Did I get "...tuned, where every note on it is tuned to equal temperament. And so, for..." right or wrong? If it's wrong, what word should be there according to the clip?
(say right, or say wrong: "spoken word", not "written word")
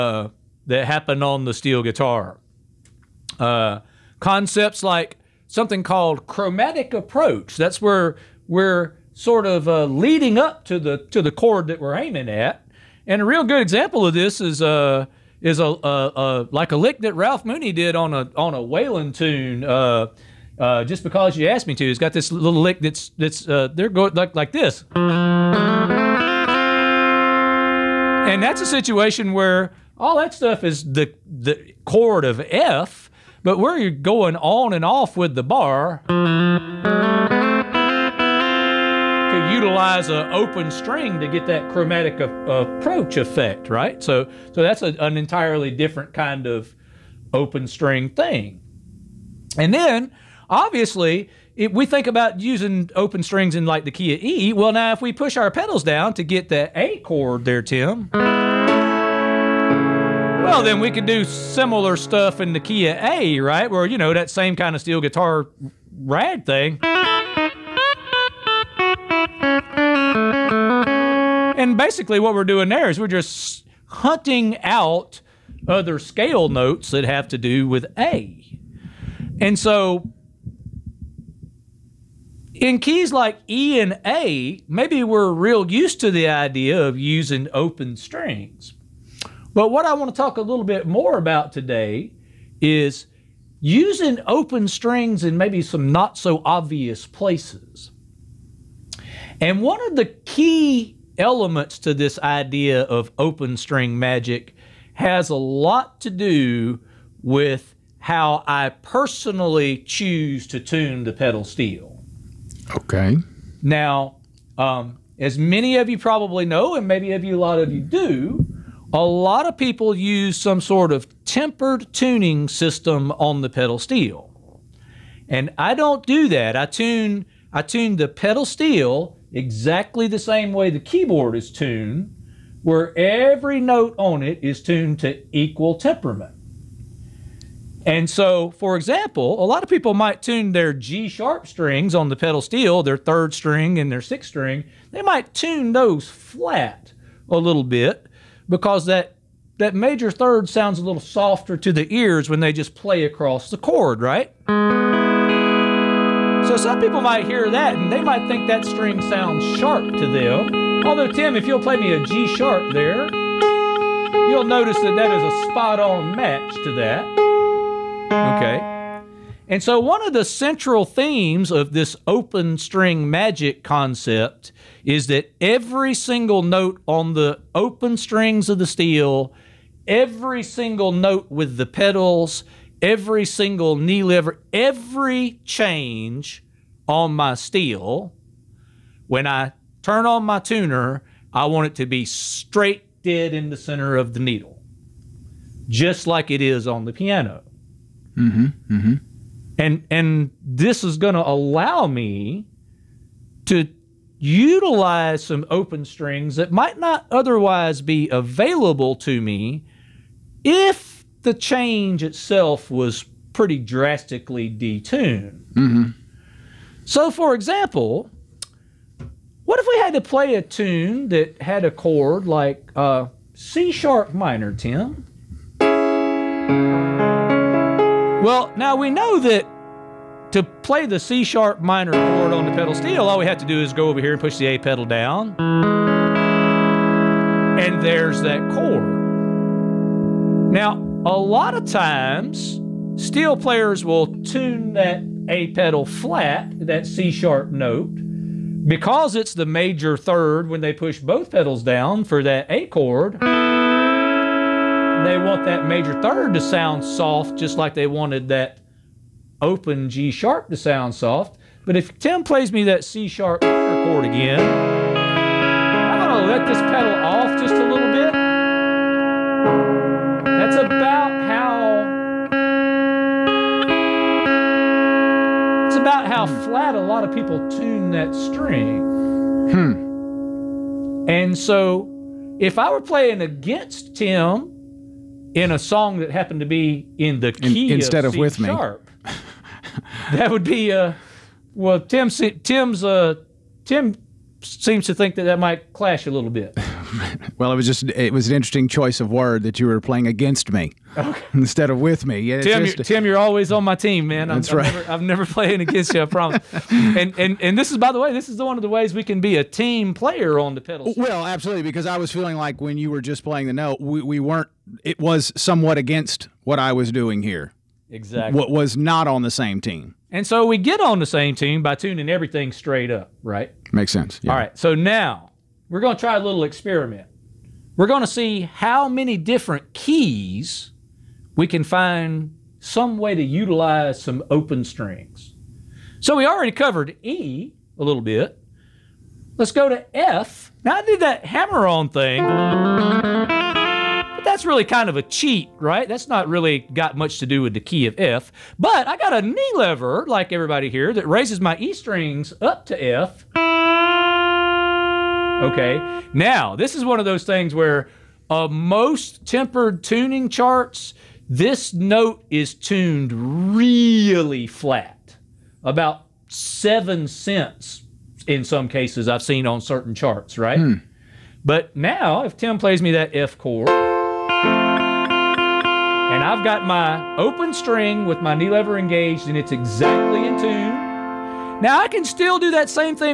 right.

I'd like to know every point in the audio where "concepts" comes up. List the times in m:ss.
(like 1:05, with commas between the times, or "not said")
0:04, 2:53.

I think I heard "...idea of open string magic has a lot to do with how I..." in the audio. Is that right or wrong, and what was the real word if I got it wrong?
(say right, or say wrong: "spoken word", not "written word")
right.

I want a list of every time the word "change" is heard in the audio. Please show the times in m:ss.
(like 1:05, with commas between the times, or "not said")
3:05, 3:31.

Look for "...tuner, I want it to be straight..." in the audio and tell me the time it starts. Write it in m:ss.
3:10.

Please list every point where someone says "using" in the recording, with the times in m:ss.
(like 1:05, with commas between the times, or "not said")
0:52, 1:26, 1:33.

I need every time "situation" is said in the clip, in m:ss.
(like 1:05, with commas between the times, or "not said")
0:28.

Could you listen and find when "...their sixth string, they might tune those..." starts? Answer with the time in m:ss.
2:23.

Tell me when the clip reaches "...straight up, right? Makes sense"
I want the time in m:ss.
5:22.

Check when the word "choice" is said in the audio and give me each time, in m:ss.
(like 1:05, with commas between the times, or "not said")
4:58.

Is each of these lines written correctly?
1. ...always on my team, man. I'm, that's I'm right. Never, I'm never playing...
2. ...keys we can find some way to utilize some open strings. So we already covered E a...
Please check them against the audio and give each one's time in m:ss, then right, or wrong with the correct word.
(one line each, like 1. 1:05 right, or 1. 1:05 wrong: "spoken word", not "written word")
1. 5:03 right
2. 5:29 right.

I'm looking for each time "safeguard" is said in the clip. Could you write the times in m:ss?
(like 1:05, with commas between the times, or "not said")
not said.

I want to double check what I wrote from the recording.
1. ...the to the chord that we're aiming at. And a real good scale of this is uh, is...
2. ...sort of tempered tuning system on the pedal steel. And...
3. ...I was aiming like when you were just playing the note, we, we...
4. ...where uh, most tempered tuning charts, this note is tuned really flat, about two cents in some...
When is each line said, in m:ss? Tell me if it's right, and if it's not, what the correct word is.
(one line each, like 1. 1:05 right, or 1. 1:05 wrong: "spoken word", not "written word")
1. 0:10 wrong: "example", not "scale"
2. 2:00 right
3. 5:11 wrong: "feeling", not "aiming"
4. 5:57 wrong: "seven", not "two".